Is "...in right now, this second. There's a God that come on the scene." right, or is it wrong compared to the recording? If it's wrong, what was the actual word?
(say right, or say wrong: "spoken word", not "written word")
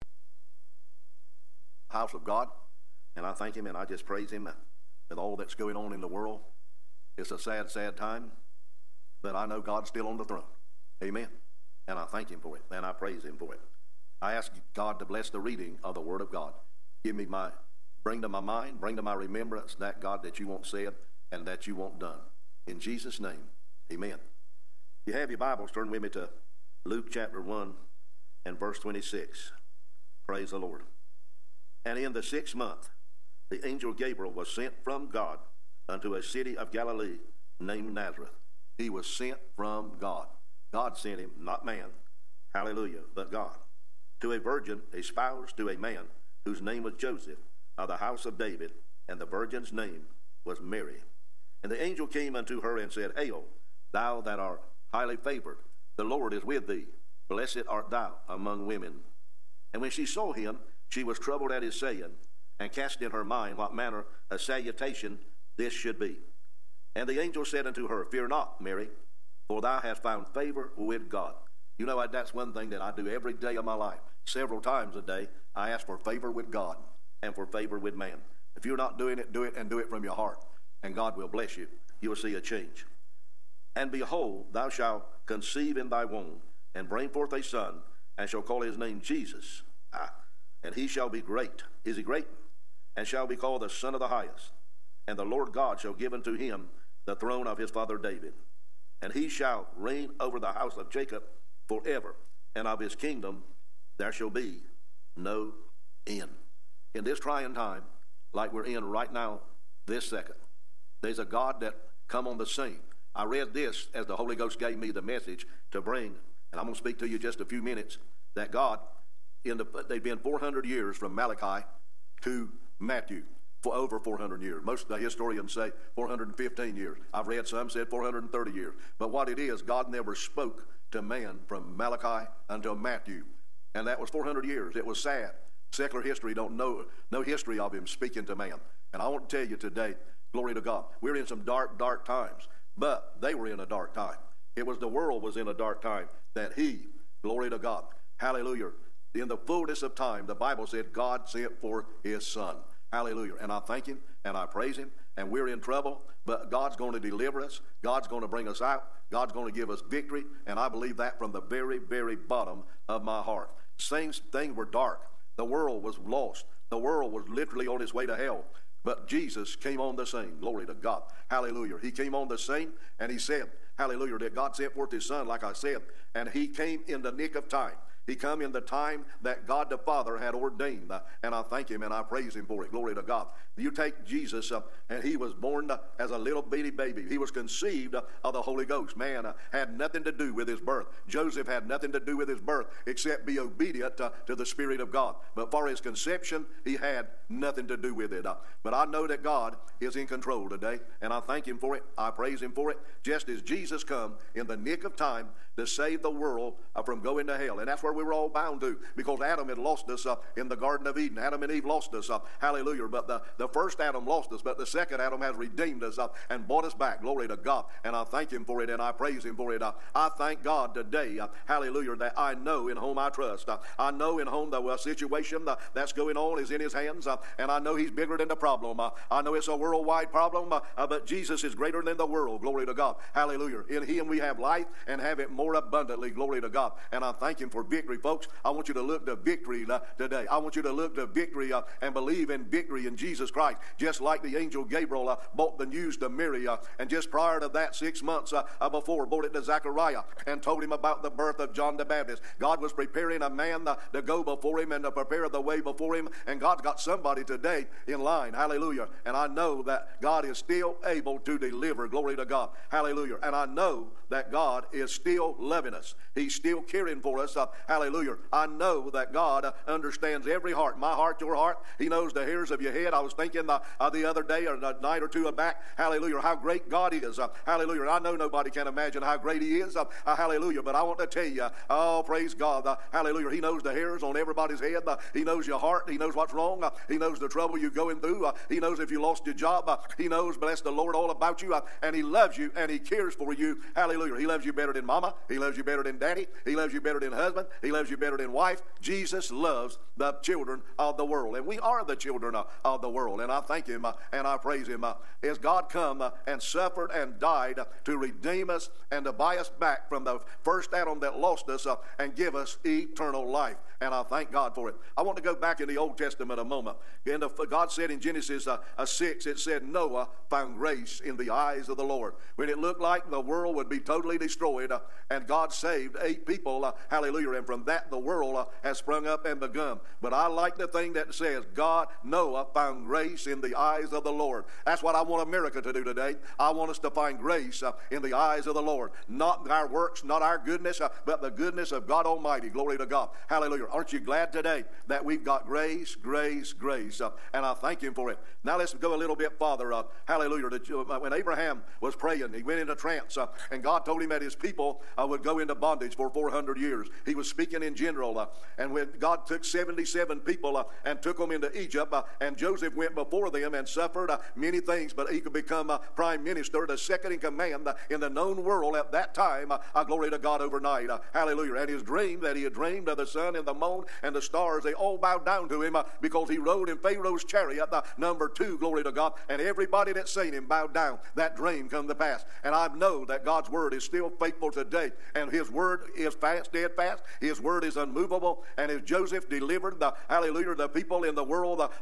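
right.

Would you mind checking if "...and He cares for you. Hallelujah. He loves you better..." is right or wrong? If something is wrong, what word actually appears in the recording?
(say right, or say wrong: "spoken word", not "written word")
right.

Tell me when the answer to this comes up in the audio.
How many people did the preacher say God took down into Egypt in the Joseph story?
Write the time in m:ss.
5:59.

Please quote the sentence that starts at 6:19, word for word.
And everybody that's seen him bowed down.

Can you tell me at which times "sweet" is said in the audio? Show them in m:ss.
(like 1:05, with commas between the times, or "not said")
not said.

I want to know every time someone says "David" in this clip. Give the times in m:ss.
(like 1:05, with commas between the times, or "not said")
0:48, 1:37.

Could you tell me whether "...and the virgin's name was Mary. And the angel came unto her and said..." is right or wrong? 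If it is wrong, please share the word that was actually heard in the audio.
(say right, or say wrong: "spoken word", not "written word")
right.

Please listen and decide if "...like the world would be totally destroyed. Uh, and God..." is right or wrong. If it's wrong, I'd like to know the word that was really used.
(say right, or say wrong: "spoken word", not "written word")
right.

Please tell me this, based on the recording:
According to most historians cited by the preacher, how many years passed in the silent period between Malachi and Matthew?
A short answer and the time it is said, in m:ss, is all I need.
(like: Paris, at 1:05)
415, at 2:05.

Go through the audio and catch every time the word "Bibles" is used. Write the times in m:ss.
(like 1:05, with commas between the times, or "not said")
0:25, 2:30.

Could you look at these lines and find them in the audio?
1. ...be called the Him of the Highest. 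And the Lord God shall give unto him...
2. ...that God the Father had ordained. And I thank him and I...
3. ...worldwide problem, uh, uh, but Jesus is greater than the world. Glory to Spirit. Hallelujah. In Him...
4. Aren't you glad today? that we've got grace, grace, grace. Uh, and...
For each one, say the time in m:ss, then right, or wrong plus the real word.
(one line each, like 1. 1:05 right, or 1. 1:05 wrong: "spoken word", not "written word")
1. 1:33 wrong: "Son", not "Him"
2. 2:59 right
3. 3:49 wrong: "God", not "Spirit"
4. 5:43 right.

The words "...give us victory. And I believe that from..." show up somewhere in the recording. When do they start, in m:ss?
2:39.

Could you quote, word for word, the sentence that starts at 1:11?
You know, I, that's one thing that I do every day of my life.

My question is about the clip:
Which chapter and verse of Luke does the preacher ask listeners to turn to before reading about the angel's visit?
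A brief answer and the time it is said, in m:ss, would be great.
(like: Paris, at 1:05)
Chapter 1 verse 26, at 0:26.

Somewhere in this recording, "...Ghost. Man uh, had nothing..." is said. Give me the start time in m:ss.
3:08.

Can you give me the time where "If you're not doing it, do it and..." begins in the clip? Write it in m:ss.
1:18.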